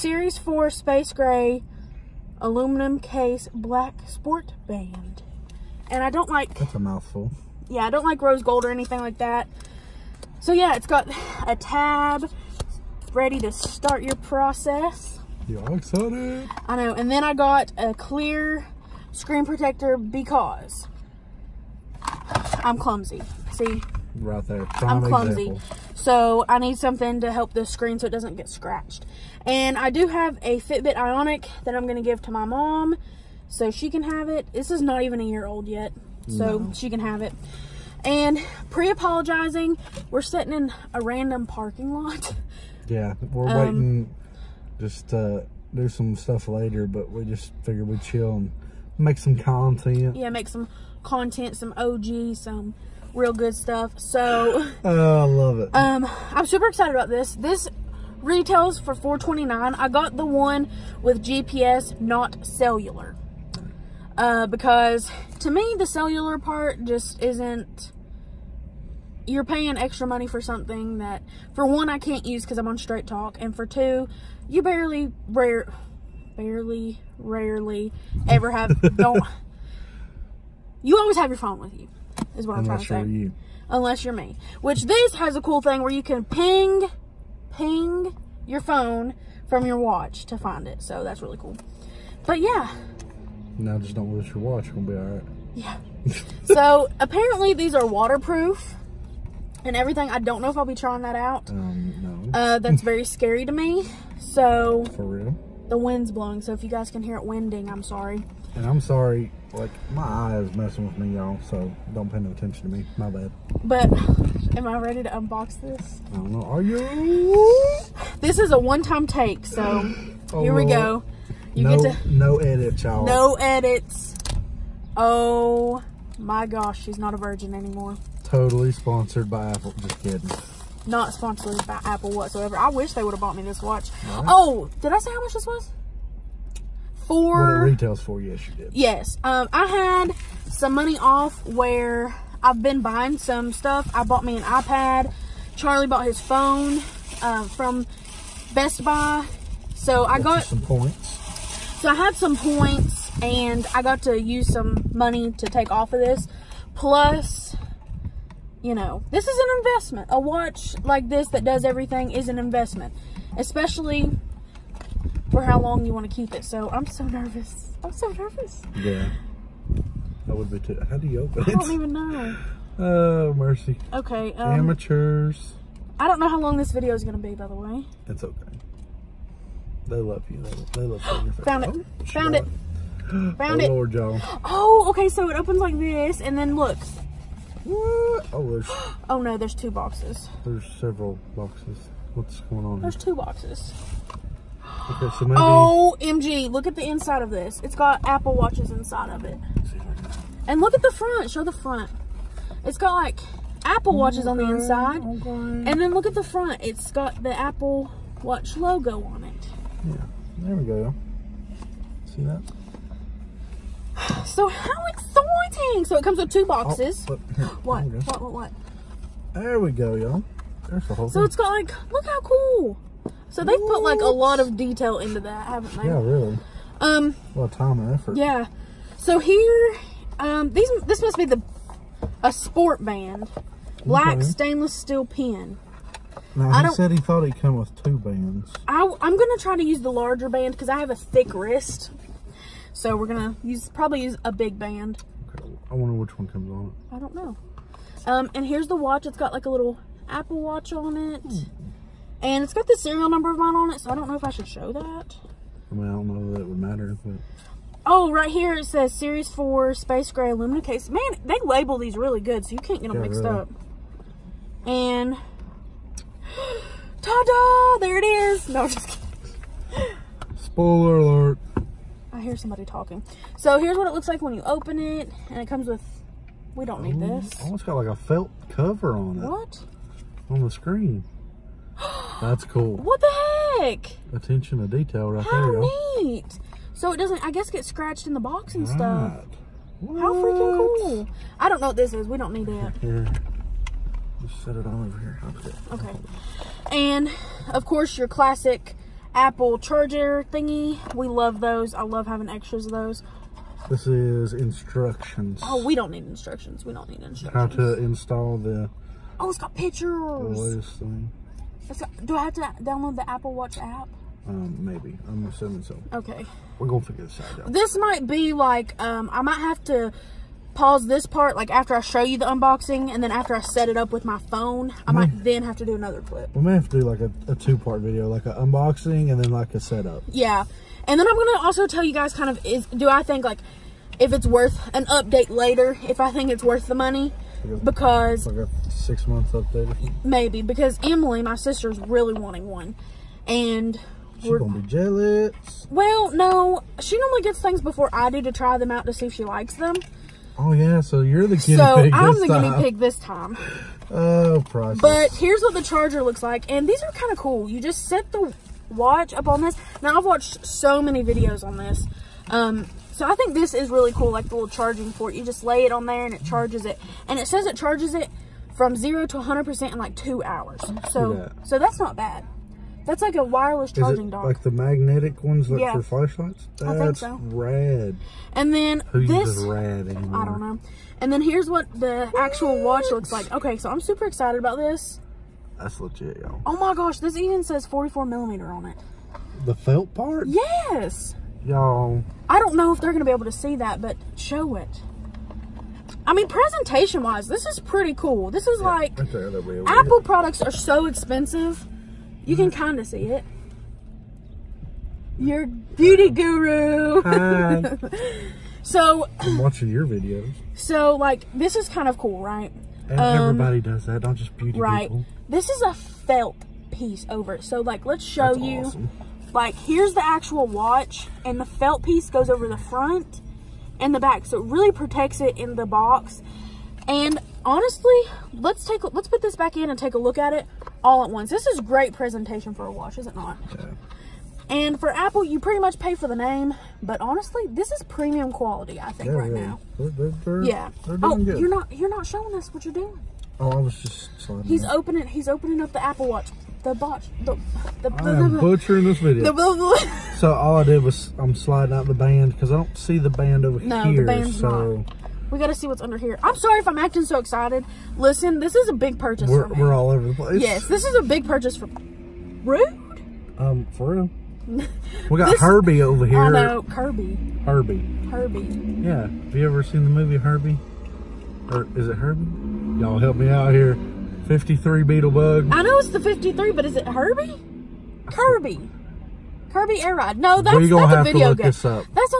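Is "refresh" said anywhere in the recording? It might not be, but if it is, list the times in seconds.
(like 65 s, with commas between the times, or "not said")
not said.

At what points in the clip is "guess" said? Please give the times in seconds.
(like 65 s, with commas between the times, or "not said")
287 s.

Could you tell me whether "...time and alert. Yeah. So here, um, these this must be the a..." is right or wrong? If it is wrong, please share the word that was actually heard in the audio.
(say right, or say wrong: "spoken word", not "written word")
wrong: "effort", not "alert".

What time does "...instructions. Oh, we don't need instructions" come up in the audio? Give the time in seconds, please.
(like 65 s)
304 s.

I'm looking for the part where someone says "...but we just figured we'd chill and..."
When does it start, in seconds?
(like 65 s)
46 s.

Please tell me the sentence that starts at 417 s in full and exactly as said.
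So, like, let's show That's you.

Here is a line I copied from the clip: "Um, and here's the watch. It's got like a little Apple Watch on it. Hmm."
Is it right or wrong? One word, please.
right.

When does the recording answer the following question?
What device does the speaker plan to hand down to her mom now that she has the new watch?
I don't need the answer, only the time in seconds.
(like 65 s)
30 s.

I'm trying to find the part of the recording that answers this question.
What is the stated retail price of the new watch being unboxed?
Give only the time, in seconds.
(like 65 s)
58 s.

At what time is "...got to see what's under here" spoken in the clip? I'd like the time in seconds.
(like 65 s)
455 s.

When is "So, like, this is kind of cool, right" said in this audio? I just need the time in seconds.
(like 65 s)
410 s.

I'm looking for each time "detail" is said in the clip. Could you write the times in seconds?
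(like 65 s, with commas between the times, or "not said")
224 s, 284 s.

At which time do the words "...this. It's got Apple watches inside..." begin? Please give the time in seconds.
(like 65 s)
197 s.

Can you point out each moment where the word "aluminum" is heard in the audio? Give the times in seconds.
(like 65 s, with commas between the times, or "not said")
2 s, 260 s.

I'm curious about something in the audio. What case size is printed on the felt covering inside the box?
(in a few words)
44 millimeter.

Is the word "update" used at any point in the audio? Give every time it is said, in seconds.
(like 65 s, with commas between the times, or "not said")
334 s, 339 s.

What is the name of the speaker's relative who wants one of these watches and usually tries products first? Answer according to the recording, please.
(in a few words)
Emily.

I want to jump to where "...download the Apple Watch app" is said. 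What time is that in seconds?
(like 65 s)
312 s.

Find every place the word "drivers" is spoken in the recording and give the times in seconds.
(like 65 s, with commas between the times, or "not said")
not said.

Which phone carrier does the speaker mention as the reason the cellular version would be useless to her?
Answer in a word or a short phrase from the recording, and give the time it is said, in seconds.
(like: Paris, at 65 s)
Straight Talk, at 72 s.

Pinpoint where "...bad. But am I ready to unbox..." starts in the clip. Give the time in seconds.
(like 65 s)
113 s.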